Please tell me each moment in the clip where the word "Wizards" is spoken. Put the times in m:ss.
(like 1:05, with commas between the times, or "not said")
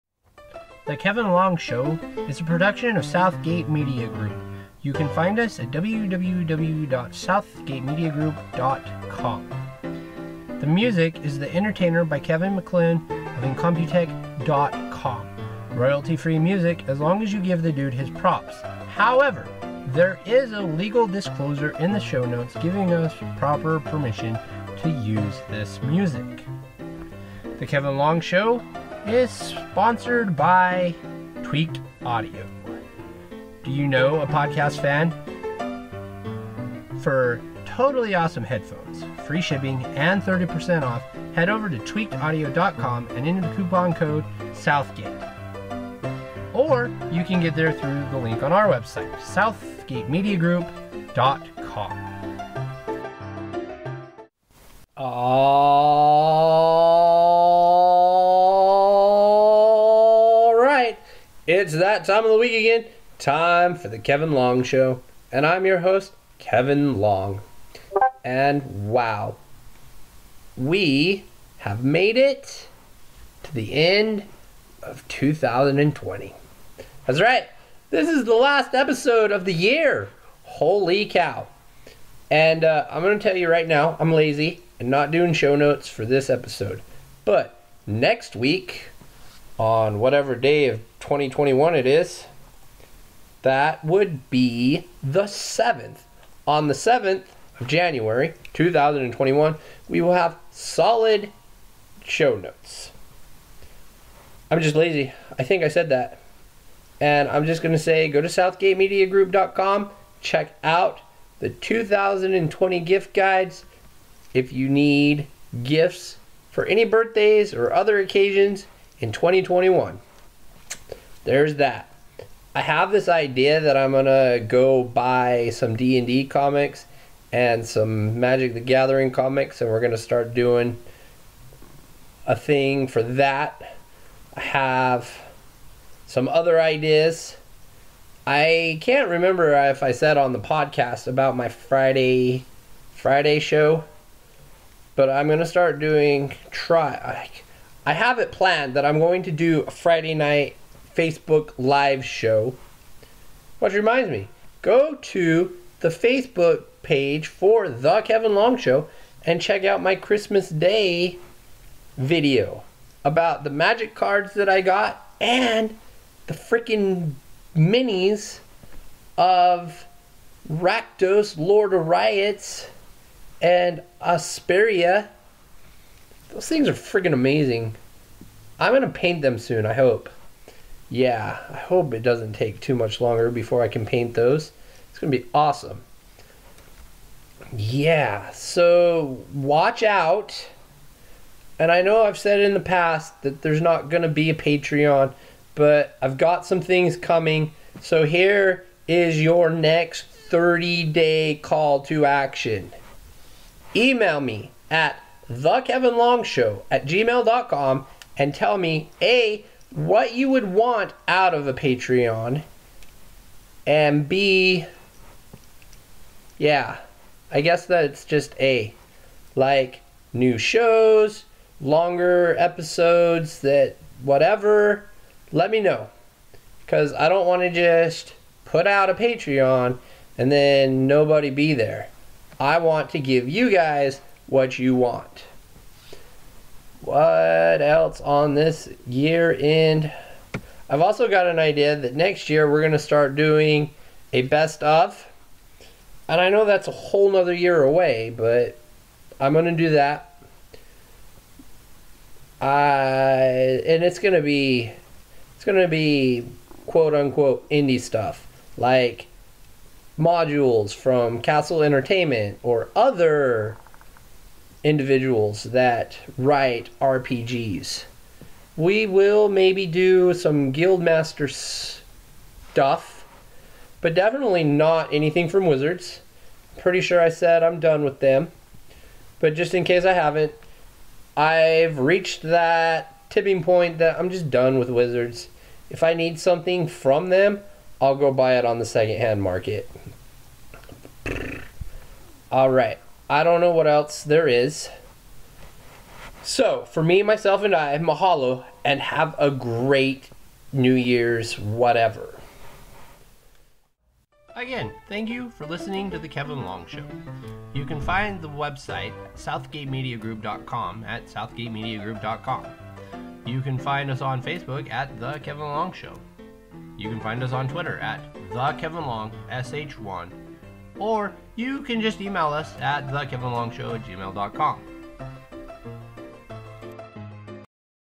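4:35, 4:44.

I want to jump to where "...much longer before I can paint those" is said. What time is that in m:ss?
3:02.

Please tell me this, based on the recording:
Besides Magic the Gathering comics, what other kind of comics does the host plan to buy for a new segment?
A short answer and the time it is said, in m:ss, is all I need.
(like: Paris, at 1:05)
D and D, at 2:05.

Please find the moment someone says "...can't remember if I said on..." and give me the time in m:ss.
2:18.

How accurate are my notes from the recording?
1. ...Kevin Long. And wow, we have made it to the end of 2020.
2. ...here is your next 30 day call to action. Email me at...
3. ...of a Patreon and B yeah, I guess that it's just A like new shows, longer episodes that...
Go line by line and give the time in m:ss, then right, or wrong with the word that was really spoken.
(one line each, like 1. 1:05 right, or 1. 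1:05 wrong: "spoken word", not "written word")
1. 1:06 right
2. 3:18 right
3. 3:31 right.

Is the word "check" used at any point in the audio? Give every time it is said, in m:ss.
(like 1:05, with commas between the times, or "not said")
1:50, 2:39.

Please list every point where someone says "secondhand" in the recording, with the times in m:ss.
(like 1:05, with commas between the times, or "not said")
4:48.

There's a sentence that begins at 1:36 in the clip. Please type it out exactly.
On the 7th of January 2021, we will have solid show notes.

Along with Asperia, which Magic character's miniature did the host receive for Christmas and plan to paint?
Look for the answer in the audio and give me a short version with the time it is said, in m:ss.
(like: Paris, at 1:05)
Rakdos, Lord of Riots, at 2:50.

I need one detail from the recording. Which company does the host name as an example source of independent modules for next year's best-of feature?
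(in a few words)
Castle Entertainment.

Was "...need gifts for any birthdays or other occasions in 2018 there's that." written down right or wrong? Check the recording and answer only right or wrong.
wrong.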